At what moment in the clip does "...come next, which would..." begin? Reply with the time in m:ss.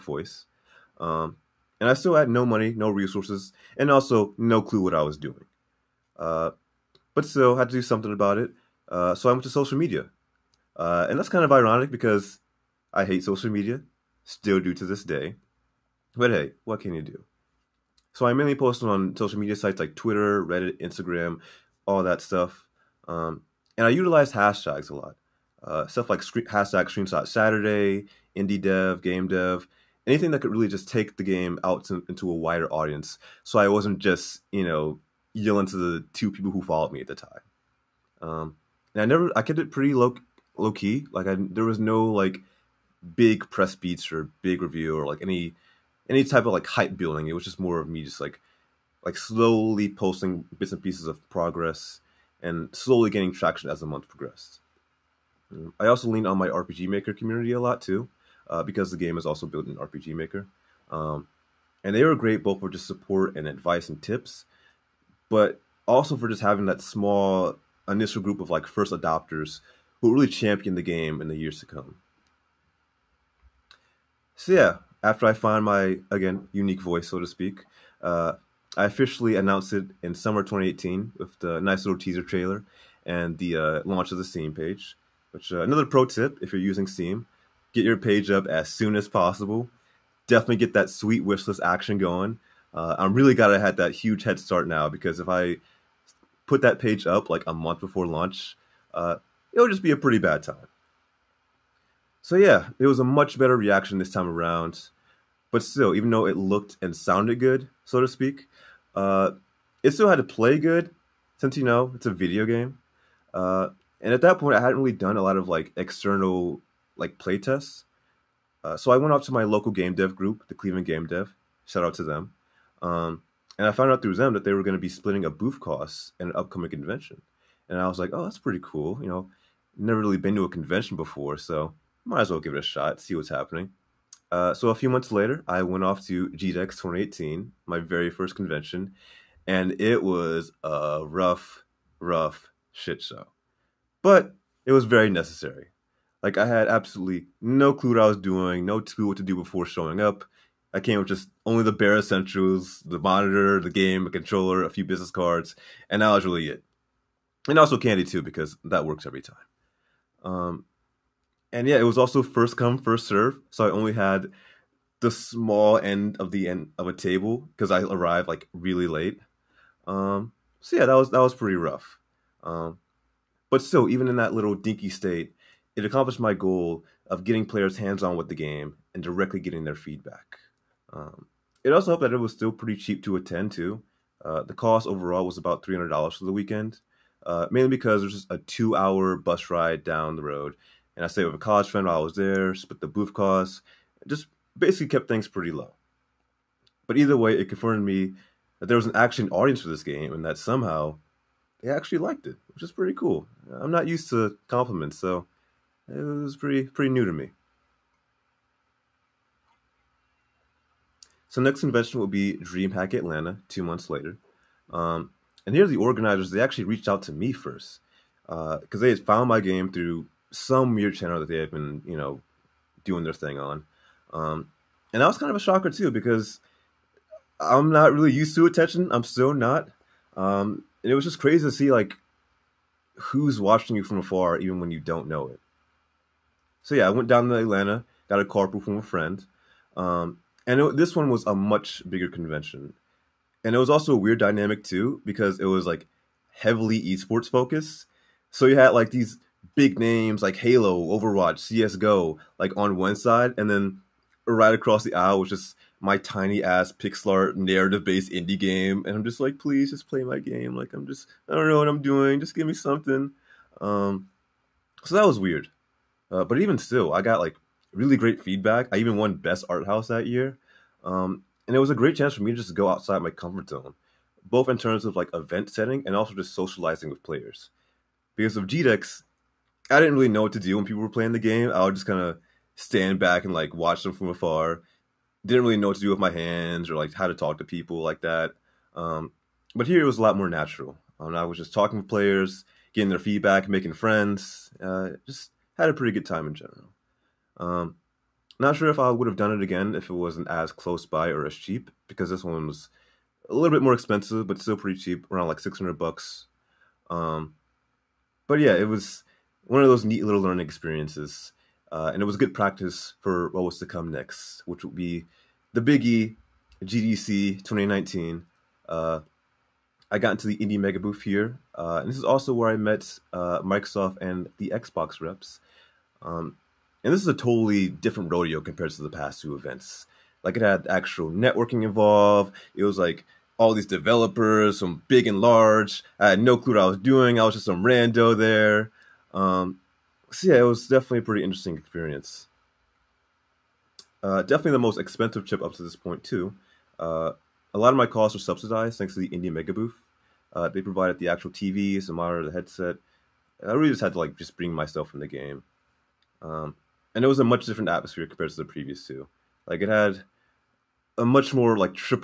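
5:13.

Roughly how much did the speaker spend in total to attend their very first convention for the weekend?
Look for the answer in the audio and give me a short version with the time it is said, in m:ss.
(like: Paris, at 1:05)
$300, at 3:05.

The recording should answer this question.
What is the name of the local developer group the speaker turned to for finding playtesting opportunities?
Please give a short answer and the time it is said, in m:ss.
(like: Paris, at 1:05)
Cleveland Game Dev, at 2:00.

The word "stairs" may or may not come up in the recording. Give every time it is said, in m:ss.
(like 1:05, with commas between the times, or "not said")
not said.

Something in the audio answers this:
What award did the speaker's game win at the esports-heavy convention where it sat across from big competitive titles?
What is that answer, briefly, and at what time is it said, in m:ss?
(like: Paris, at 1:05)
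best art house, at 4:29.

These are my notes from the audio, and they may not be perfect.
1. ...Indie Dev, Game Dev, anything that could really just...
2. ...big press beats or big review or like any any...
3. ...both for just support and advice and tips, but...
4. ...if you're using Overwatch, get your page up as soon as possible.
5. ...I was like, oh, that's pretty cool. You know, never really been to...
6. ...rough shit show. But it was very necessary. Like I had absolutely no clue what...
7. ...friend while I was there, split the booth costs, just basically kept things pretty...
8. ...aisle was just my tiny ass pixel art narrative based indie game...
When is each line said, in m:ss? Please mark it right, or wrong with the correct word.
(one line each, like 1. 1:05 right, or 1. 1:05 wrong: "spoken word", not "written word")
1. 0:28 right
2. 0:43 right
3. 1:02 right
4. 1:26 wrong: "Steam", not "Overwatch"
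5. 2:07 right
6. 2:21 right
7. 3:11 right
8. 4:14 right.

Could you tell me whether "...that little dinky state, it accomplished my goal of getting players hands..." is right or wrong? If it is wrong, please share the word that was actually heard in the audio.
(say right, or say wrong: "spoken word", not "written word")
right.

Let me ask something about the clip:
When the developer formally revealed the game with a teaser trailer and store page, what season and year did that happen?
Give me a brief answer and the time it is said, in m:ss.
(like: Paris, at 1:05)
summer 2018, at 1:20.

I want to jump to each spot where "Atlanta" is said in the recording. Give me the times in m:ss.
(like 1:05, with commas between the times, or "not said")
3:32, 3:57.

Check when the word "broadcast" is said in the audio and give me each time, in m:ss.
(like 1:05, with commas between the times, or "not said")
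not said.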